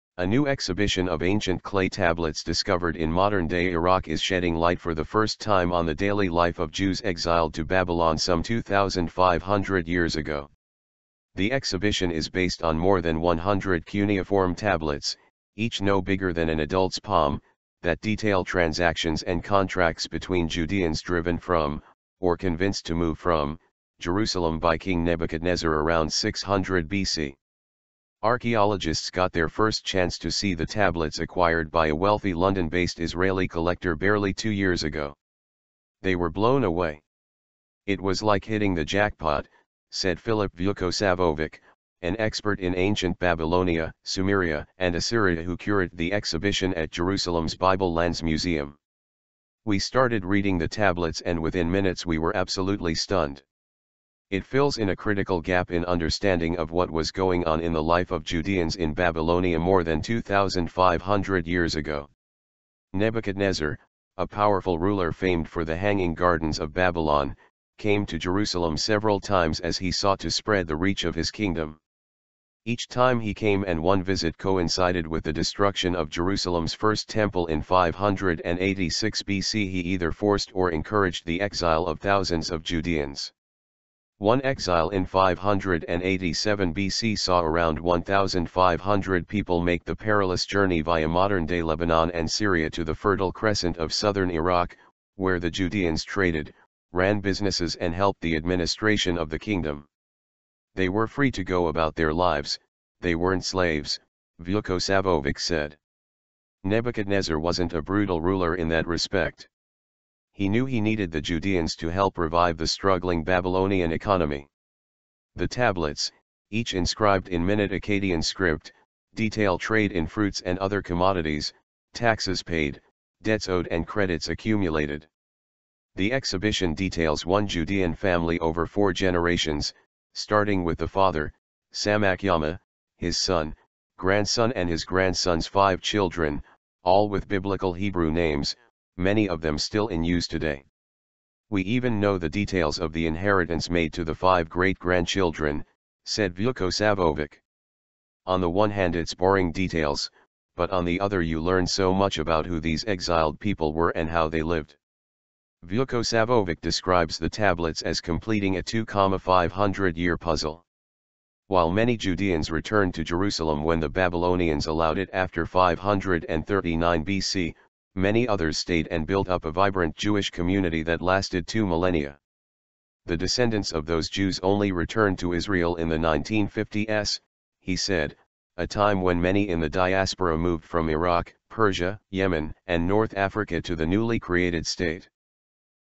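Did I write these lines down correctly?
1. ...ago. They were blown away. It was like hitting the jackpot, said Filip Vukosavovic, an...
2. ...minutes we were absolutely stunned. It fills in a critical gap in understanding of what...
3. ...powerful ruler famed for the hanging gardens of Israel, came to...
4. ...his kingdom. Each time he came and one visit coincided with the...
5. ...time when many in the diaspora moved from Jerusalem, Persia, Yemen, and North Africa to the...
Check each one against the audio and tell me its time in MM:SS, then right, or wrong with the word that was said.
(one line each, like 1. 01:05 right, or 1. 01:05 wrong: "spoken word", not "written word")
1. 00:34 right
2. 00:51 right
3. 01:04 wrong: "Babylon", not "Israel"
4. 01:11 right
5. 02:58 wrong: "Iraq", not "Jerusalem".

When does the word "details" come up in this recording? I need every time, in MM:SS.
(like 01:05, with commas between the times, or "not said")
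00:18, 01:59, 02:06, 02:22, 02:29.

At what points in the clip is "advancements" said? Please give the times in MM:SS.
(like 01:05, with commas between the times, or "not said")
not said.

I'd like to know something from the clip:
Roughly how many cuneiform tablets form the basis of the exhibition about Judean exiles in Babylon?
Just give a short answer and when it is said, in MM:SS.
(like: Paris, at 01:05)
more than 100, at 00:12.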